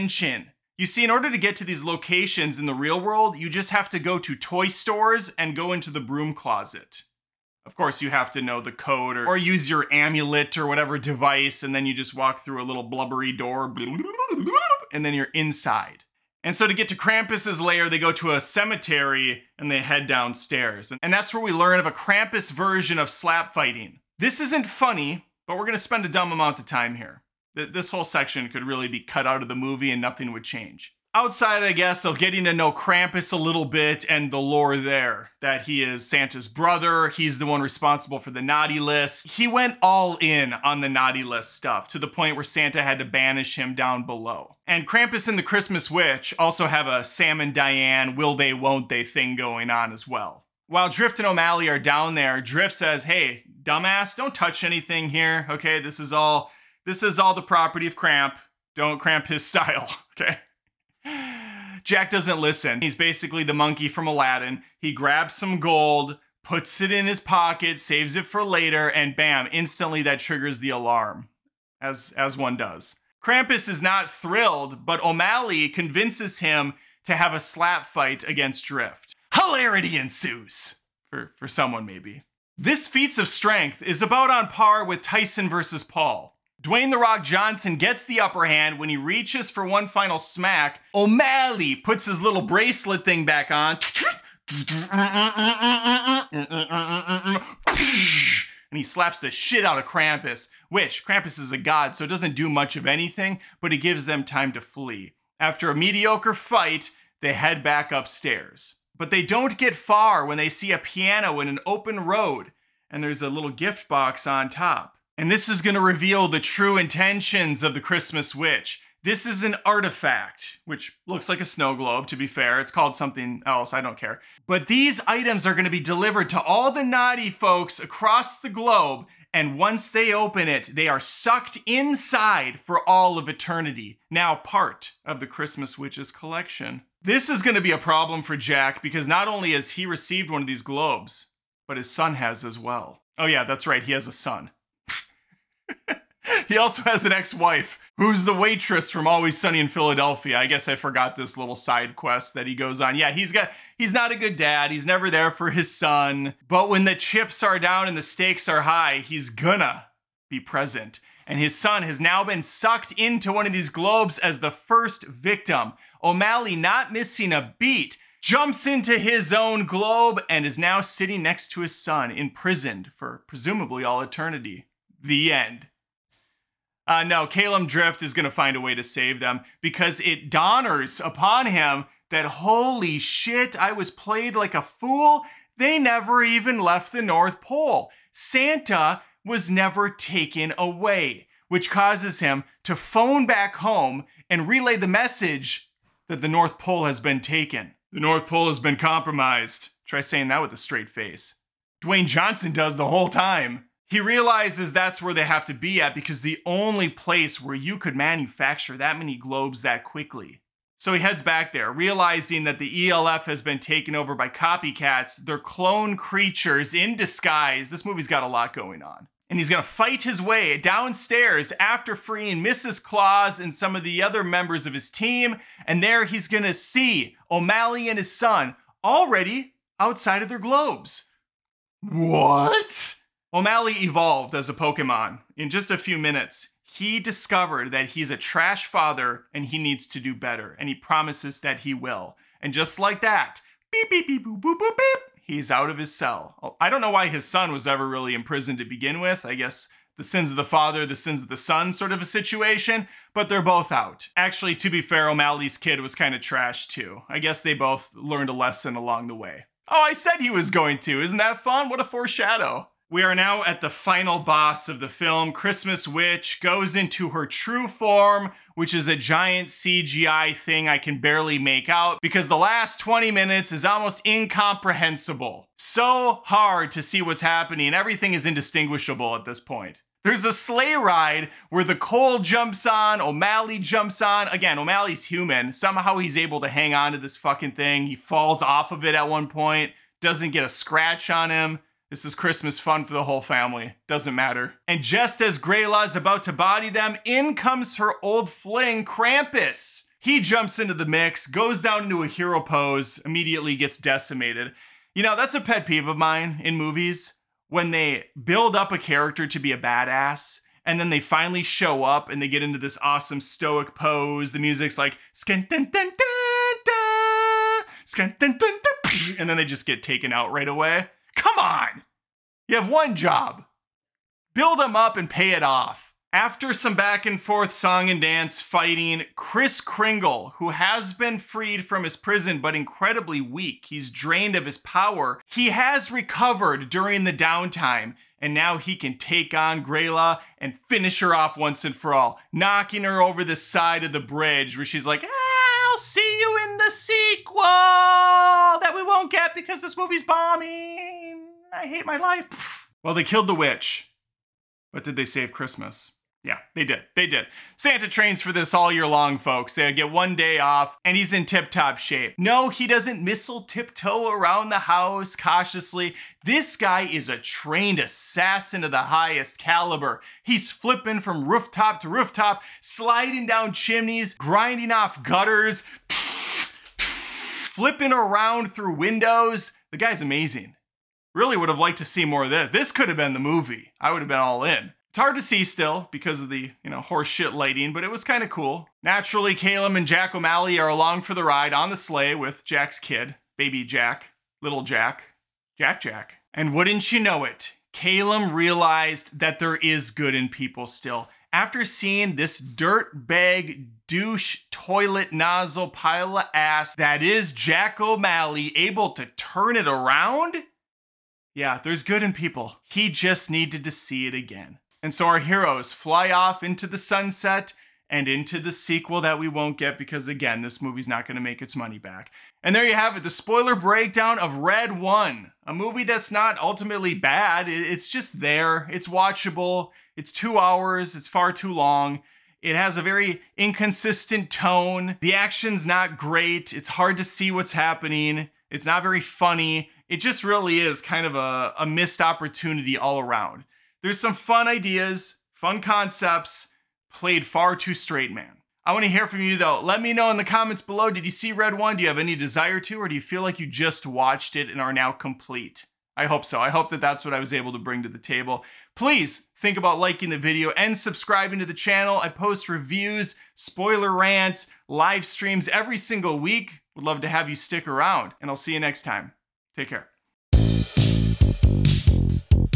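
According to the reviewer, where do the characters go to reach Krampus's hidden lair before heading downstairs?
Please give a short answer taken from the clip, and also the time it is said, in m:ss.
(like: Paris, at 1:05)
A cemetery, at 0:18.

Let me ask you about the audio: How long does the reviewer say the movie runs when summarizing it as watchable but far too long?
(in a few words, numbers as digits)
2 hours.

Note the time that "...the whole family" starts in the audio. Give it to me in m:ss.
4:52.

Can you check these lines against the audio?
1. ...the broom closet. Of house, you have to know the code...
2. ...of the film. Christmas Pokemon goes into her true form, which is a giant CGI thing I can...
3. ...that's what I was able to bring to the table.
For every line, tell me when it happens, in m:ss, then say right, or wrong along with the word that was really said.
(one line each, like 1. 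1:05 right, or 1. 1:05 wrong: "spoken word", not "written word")
1. 0:05 wrong: "course", not "house"
2. 4:24 wrong: "Witch", not "Pokemon"
3. 7:36 right.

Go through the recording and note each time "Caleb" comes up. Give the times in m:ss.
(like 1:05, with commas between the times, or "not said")
6:29, 6:37.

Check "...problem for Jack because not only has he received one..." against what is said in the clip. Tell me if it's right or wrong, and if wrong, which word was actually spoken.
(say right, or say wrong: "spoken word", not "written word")
right.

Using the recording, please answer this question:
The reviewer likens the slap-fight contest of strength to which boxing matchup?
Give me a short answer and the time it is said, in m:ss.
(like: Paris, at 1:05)
Tyson versus Paul, at 1:25.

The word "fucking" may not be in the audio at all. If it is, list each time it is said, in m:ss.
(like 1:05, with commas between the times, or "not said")
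4:47.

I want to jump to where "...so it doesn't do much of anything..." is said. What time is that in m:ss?
1:41.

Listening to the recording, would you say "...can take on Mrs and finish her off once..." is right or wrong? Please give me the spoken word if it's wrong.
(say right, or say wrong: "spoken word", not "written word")
wrong: "Grayla", not "Mrs".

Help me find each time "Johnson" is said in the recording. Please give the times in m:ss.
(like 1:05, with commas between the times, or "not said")
1:27, 3:22.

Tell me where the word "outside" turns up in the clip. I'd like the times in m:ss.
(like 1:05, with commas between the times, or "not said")
0:31, 3:49.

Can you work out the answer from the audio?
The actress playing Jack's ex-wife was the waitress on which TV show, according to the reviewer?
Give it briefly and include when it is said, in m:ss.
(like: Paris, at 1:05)
Always Sunny in Philadelphia, at 2:29.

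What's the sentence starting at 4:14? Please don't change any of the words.
Actually, to be fair, O'Malley's kid was kind of trash too.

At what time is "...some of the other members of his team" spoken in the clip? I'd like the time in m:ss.
3:43.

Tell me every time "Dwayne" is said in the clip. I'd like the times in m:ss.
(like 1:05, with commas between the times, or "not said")
1:26, 3:21.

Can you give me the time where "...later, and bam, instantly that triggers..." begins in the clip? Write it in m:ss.
1:08.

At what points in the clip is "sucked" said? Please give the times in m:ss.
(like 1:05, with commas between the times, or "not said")
2:10, 2:42.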